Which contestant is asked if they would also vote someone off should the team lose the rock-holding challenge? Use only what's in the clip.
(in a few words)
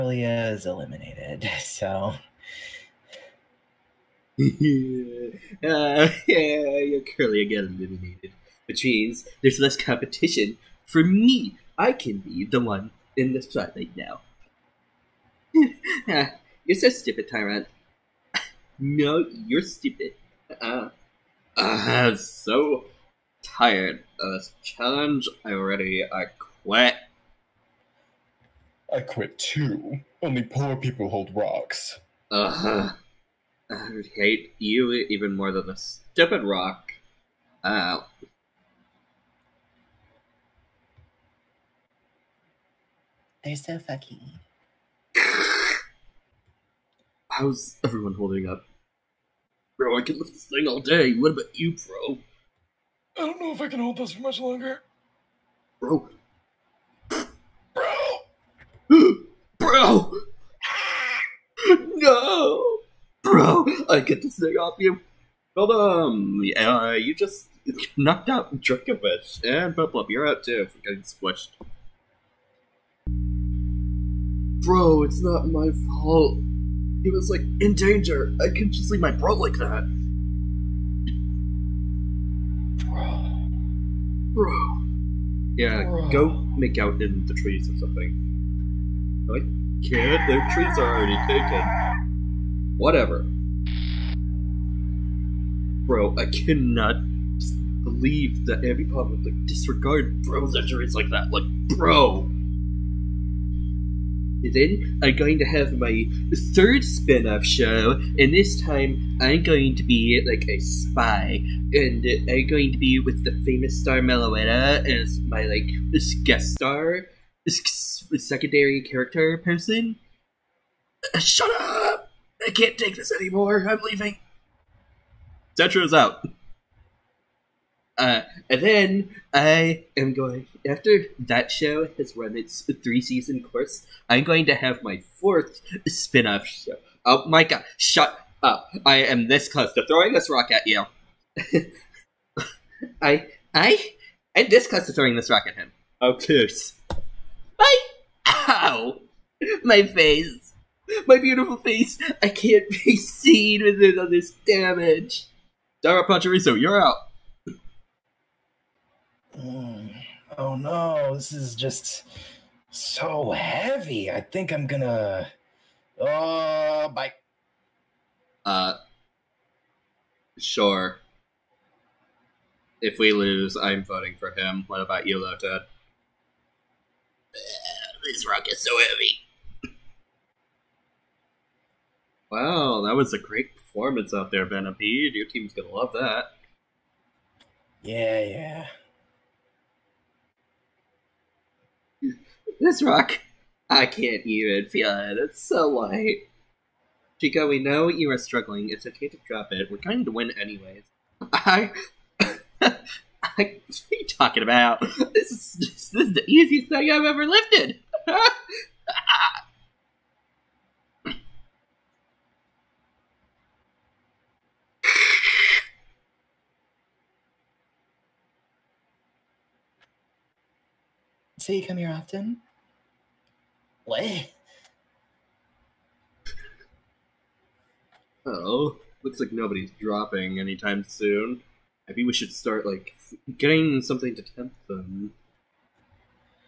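Lotad.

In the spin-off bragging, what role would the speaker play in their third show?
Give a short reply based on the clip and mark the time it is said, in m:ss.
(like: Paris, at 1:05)
A spy, at 1:50.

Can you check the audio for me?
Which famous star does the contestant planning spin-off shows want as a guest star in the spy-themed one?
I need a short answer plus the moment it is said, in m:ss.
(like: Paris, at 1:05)
Meloetta, at 1:53.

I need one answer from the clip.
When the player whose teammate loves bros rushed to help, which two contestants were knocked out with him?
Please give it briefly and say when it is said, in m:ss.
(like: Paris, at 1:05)
Dracovish and Bubblup, at 1:08.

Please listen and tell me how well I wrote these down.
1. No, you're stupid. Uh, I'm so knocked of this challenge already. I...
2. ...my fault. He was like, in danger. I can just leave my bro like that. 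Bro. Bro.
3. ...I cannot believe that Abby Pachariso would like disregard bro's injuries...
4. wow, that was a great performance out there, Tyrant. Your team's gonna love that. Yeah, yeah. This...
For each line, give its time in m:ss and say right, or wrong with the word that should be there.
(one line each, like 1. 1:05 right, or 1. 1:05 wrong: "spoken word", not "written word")
1. 0:18 wrong: "tired", not "knocked"
2. 1:15 right
3. 1:36 wrong: "Pop", not "Pachariso"
4. 3:02 wrong: "Venipede", not "Tyrant".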